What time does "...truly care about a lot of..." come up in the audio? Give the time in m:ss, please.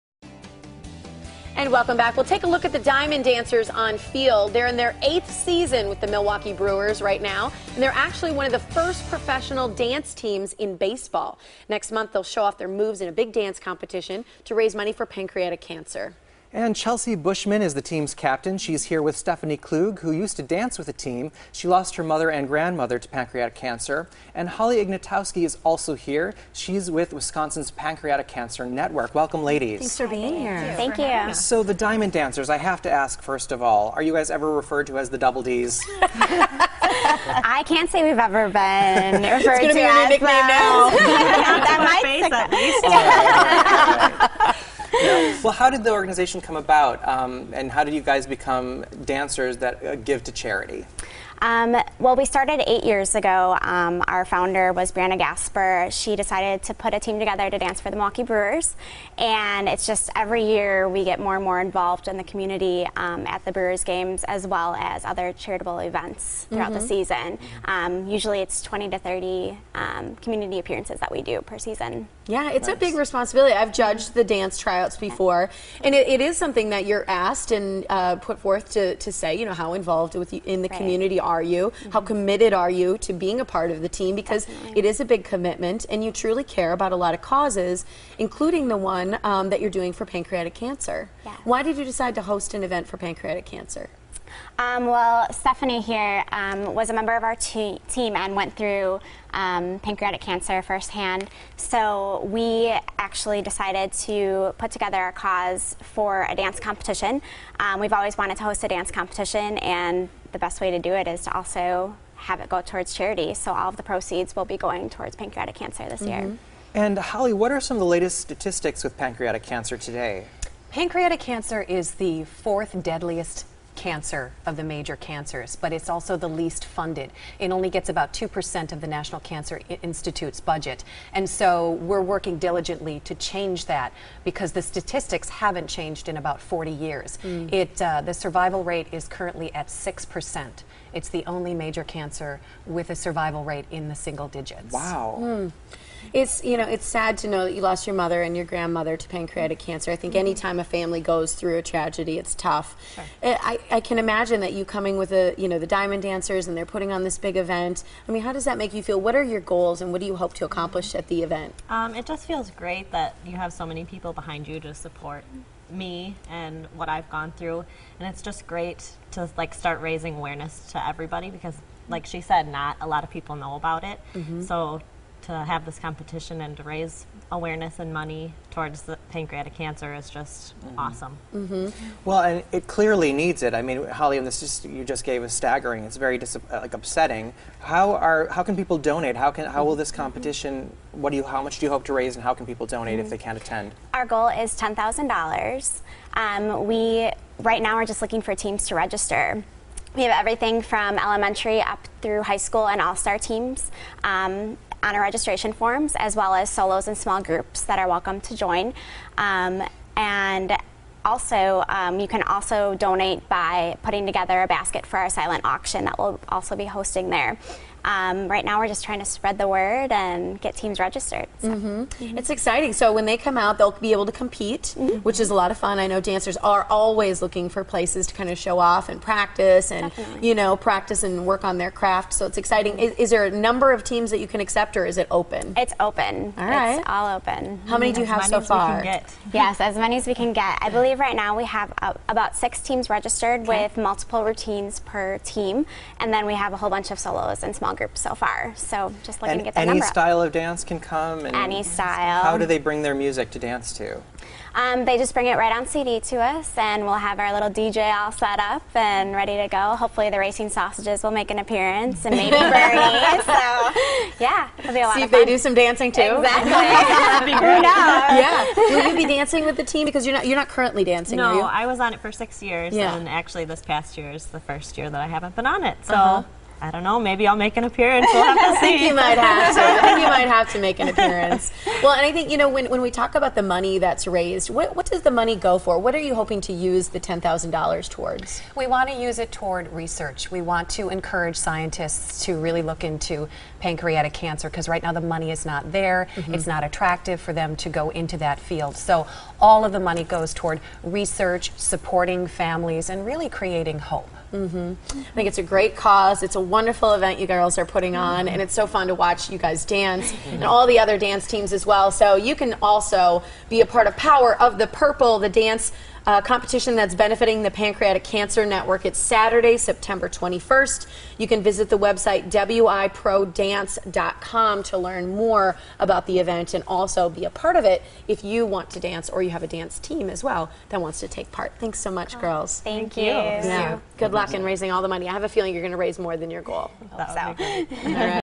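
1:26.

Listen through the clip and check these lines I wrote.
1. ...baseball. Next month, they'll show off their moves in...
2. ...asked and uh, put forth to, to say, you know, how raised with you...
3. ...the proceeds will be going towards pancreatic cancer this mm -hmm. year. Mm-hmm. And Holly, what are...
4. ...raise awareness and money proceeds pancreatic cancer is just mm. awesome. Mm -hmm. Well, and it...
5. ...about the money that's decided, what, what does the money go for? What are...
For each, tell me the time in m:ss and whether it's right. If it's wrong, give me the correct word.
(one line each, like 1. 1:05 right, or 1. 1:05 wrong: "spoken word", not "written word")
1. 0:10 right
2. 1:17 wrong: "involved", not "raised"
3. 1:53 right
4. 2:56 wrong: "towards", not "proceeds"
5. 4:43 wrong: "raised", not "decided".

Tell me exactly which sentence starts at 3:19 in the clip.
We have everything from elementary up through high school and all-star teams.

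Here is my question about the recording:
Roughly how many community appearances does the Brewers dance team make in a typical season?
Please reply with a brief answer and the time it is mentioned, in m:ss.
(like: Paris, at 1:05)
20 to 30, at 1:08.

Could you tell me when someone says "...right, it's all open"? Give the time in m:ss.
3:56.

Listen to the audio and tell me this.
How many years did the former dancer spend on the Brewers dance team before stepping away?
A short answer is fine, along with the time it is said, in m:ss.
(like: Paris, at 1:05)
6, at 4:32.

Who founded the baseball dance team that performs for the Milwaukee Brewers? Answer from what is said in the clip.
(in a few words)
Brianna Gasper.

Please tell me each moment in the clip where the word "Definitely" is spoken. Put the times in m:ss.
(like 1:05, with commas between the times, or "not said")
1:24, 3:49.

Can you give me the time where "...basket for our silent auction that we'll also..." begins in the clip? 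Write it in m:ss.
3:34.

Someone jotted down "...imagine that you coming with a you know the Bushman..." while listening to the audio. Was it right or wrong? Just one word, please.
wrong.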